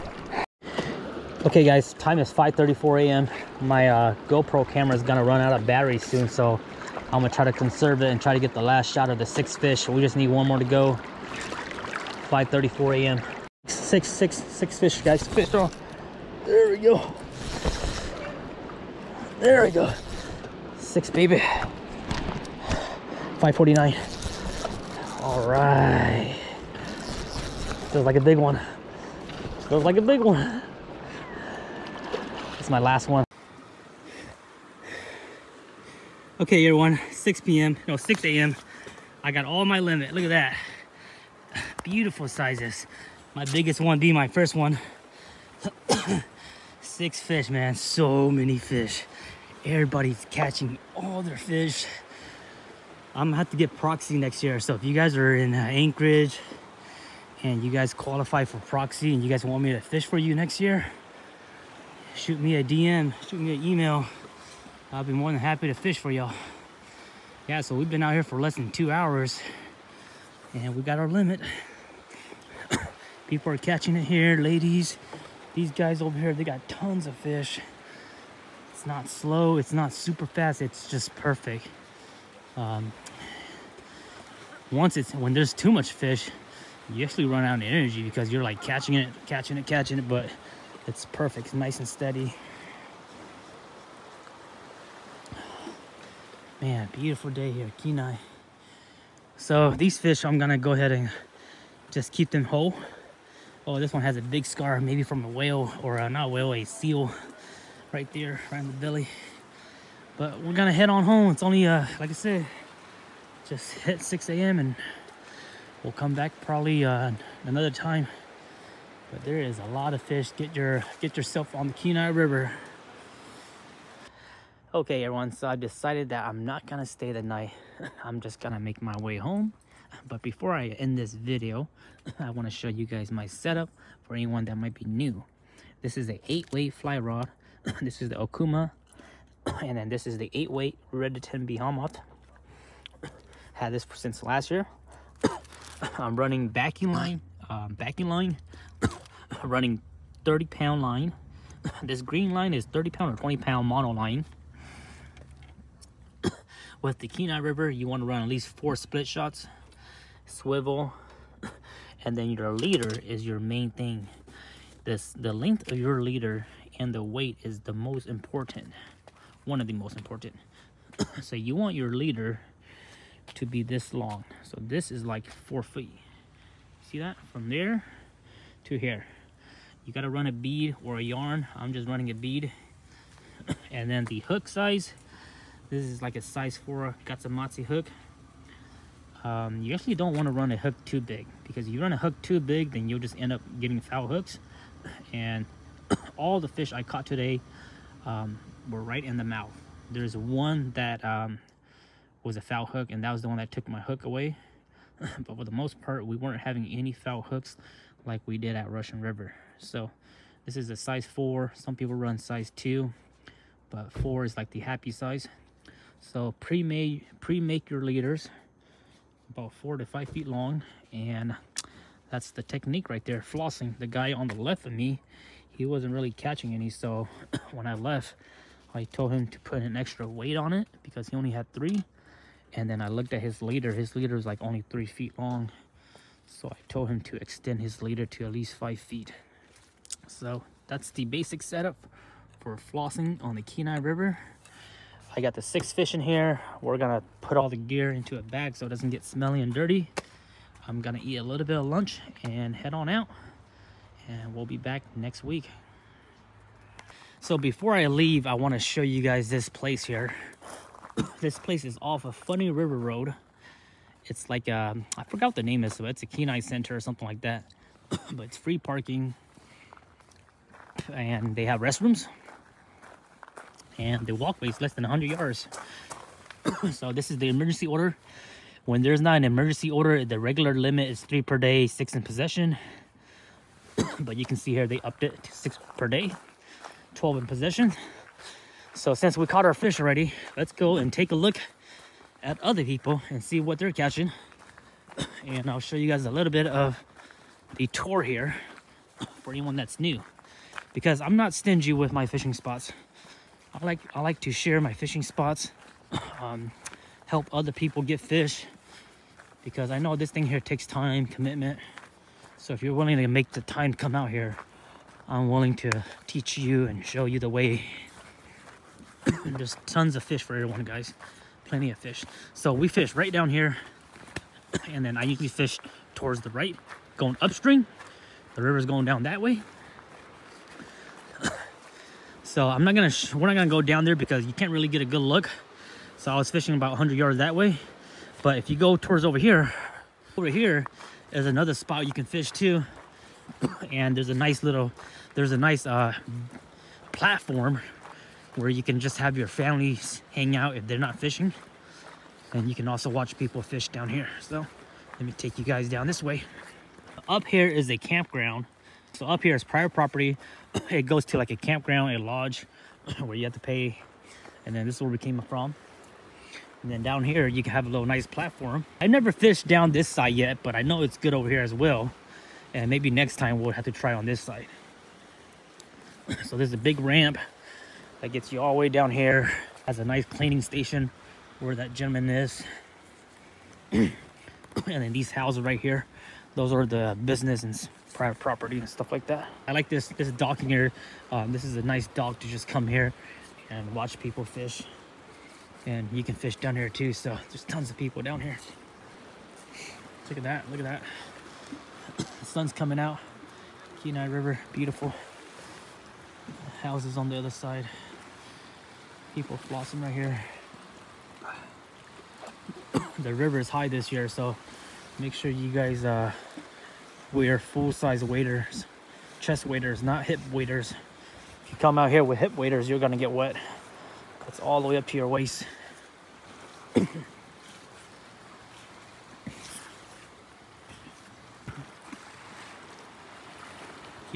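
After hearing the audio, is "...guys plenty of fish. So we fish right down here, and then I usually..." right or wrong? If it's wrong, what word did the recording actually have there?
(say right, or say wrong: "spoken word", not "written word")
right.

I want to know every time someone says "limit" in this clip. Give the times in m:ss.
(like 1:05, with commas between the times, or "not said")
0:39, 1:11, 4:40.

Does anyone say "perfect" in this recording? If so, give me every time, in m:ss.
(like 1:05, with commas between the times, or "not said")
1:21, 1:31.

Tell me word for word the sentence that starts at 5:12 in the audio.
So if you're willing to make the time come out here, I'm willing to teach you and show you the way.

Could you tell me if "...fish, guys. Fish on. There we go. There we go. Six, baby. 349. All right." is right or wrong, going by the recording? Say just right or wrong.
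wrong.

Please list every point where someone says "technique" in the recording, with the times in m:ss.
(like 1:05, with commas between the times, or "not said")
3:42.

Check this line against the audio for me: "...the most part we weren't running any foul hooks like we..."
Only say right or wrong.
wrong.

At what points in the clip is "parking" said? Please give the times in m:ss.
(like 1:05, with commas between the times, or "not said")
4:28.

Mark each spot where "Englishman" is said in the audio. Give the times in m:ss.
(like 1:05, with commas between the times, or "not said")
not said.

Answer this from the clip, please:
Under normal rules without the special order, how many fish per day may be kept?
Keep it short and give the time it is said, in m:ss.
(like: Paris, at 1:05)
3, at 4:41.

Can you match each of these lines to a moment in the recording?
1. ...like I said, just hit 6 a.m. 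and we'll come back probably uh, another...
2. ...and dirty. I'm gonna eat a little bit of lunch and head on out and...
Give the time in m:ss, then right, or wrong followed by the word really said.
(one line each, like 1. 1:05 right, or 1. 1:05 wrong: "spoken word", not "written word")
1. 1:52 right
2. 4:09 right.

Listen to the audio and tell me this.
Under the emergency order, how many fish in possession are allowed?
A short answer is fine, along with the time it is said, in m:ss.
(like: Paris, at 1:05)
12, at 4:46.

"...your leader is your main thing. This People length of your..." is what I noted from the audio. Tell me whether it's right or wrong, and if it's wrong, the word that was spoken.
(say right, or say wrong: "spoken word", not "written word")
wrong: "The", not "People".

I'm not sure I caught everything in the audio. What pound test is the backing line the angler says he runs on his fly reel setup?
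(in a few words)
30 pound.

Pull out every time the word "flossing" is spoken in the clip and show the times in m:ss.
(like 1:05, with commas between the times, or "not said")
3:43, 4:02, 6:49.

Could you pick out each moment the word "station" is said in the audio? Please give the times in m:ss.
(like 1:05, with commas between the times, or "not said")
6:20.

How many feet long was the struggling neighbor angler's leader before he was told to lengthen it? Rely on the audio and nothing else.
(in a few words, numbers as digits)
3 feet.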